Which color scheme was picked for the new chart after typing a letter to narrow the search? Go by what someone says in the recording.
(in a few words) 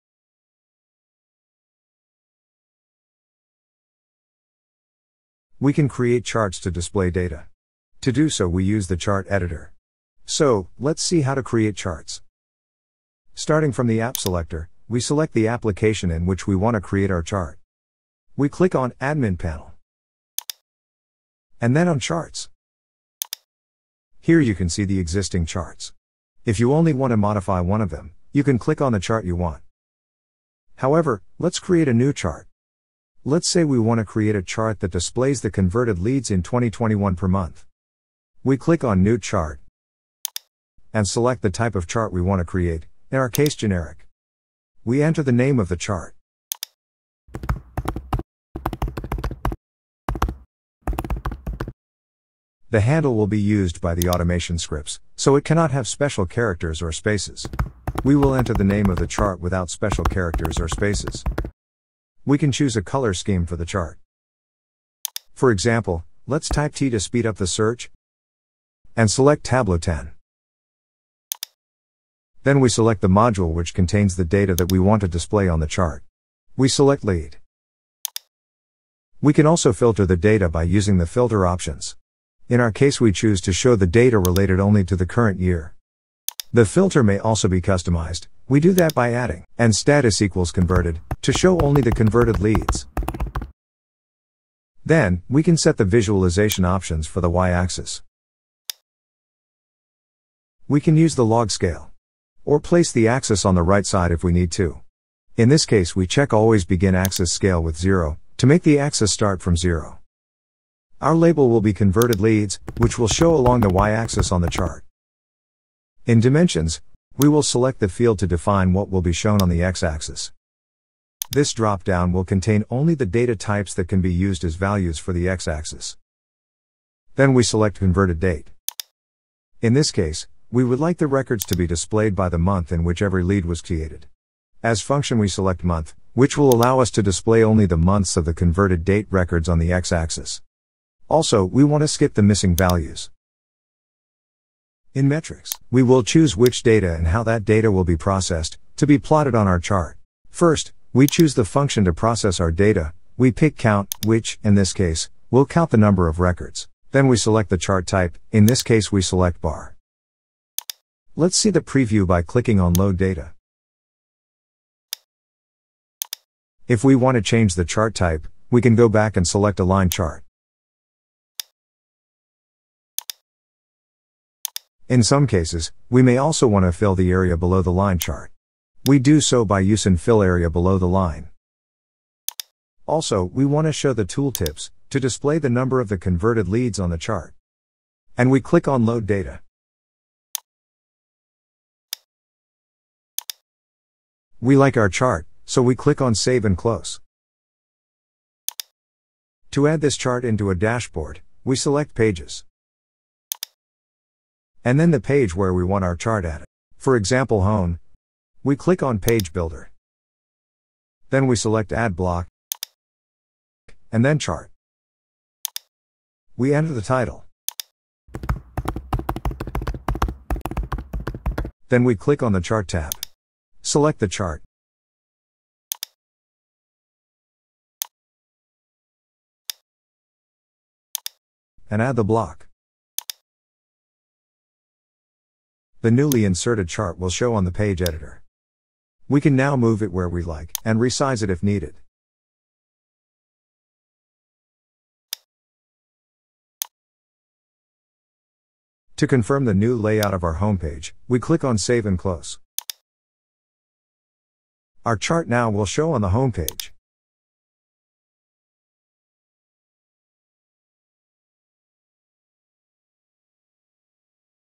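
Tableau 10.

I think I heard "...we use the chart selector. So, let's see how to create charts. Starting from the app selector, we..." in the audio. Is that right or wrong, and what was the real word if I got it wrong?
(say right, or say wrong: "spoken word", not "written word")
wrong: "editor", not "selector".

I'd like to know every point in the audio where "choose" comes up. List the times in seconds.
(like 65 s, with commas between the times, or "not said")
62 s, 83 s, 146 s, 151 s.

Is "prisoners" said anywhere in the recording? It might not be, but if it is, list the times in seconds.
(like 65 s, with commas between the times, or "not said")
not said.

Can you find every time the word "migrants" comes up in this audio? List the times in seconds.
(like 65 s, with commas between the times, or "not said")
not said.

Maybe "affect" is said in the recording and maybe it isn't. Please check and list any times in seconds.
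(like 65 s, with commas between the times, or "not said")
not said.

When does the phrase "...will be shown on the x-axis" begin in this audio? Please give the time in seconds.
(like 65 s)
118 s.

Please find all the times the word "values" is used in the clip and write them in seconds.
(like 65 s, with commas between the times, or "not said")
124 s, 142 s.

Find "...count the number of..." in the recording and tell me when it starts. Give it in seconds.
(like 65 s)
155 s.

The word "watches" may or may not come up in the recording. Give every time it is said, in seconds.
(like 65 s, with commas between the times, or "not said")
not said.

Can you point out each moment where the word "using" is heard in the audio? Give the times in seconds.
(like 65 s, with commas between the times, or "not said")
80 s, 179 s.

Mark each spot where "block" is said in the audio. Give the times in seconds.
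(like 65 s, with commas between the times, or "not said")
211 s, 232 s.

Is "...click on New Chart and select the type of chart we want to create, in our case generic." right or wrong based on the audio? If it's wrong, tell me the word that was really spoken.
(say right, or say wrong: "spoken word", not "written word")
right.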